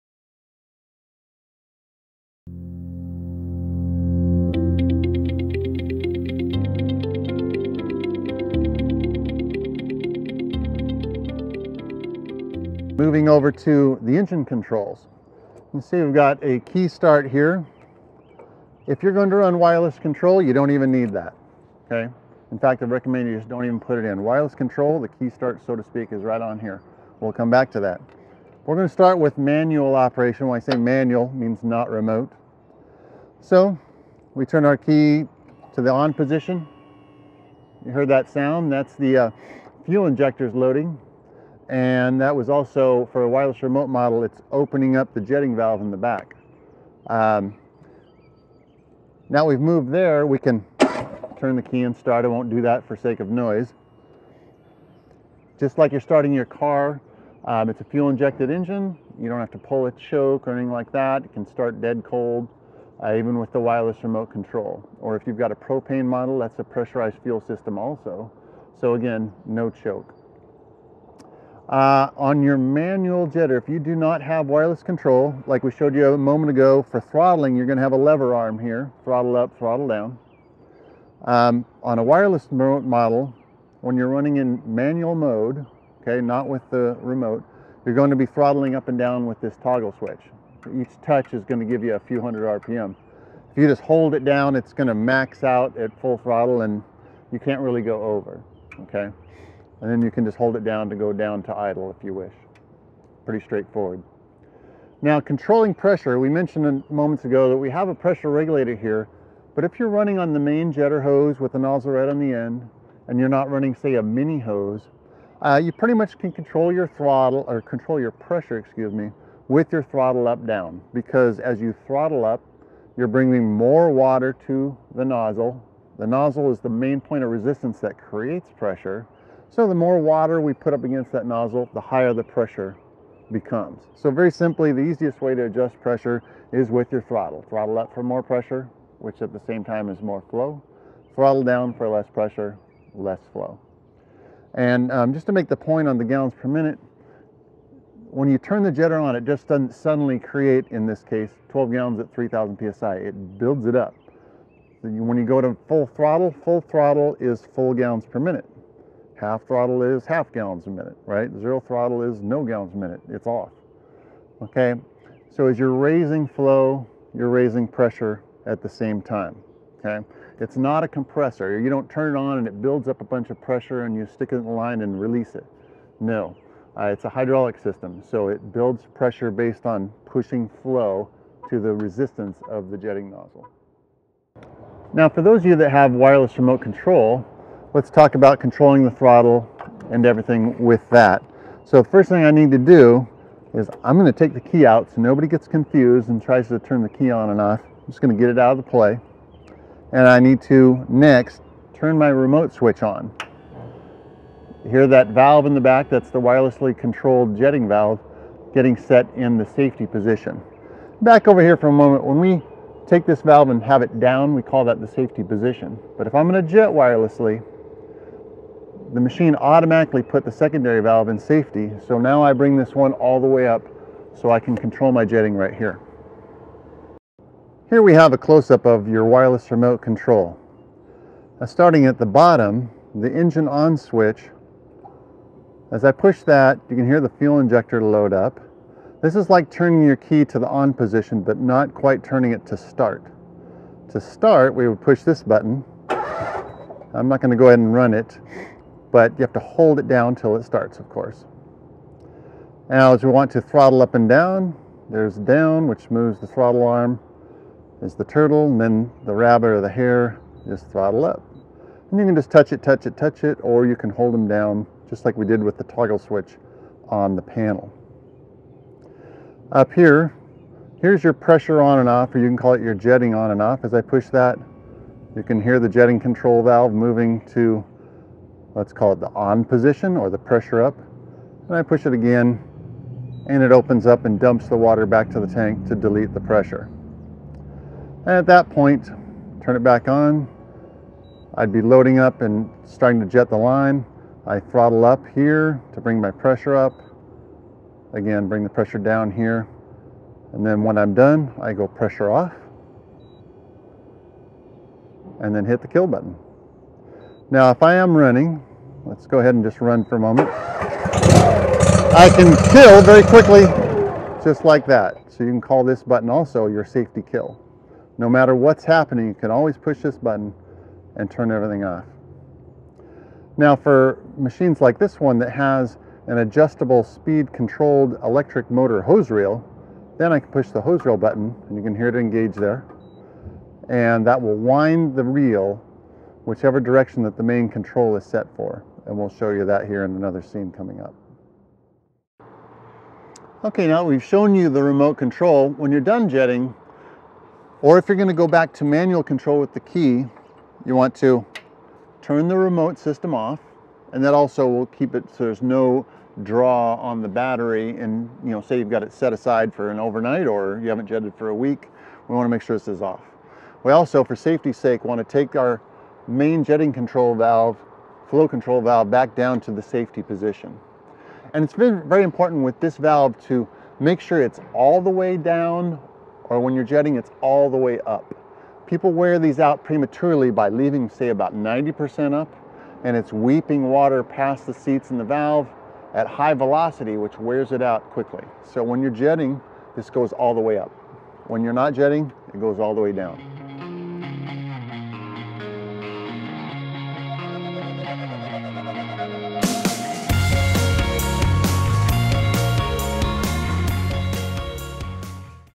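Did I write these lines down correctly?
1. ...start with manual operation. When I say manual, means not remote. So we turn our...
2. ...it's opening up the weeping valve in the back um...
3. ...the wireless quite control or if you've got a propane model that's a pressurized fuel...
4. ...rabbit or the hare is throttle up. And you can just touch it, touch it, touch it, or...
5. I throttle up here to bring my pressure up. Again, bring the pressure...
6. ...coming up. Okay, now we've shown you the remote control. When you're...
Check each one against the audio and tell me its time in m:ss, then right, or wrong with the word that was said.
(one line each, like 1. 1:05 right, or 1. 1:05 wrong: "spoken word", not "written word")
1. 0:28 right
2. 0:44 wrong: "jetting", not "weeping"
3. 1:03 wrong: "remote", not "quite"
4. 4:19 right
5. 4:54 right
6. 5:40 right.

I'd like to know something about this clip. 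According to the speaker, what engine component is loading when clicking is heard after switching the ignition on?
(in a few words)
fuel injectors.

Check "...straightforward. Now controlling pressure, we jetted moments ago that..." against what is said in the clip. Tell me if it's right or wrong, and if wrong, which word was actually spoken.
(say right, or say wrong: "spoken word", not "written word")
wrong: "mentioned", not "jetted".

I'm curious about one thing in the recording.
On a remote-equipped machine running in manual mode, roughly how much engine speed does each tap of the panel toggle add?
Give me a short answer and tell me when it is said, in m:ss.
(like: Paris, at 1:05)
a few hundred RPM, at 1:31.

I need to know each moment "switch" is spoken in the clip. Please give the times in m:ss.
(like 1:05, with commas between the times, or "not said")
1:29, 3:22, 3:53, 4:25.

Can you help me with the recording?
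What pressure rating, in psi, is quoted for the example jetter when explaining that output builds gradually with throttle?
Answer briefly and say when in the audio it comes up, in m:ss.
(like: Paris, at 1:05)
3,000 psi, at 2:32.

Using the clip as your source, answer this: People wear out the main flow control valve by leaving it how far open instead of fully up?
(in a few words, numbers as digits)
90%.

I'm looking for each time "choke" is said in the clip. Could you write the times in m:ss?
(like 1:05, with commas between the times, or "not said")
0:59, 1:09.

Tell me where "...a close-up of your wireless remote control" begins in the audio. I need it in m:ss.
3:48.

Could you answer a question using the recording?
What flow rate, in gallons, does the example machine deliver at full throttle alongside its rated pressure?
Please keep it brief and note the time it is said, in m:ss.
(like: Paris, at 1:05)
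12 gallons, at 2:31.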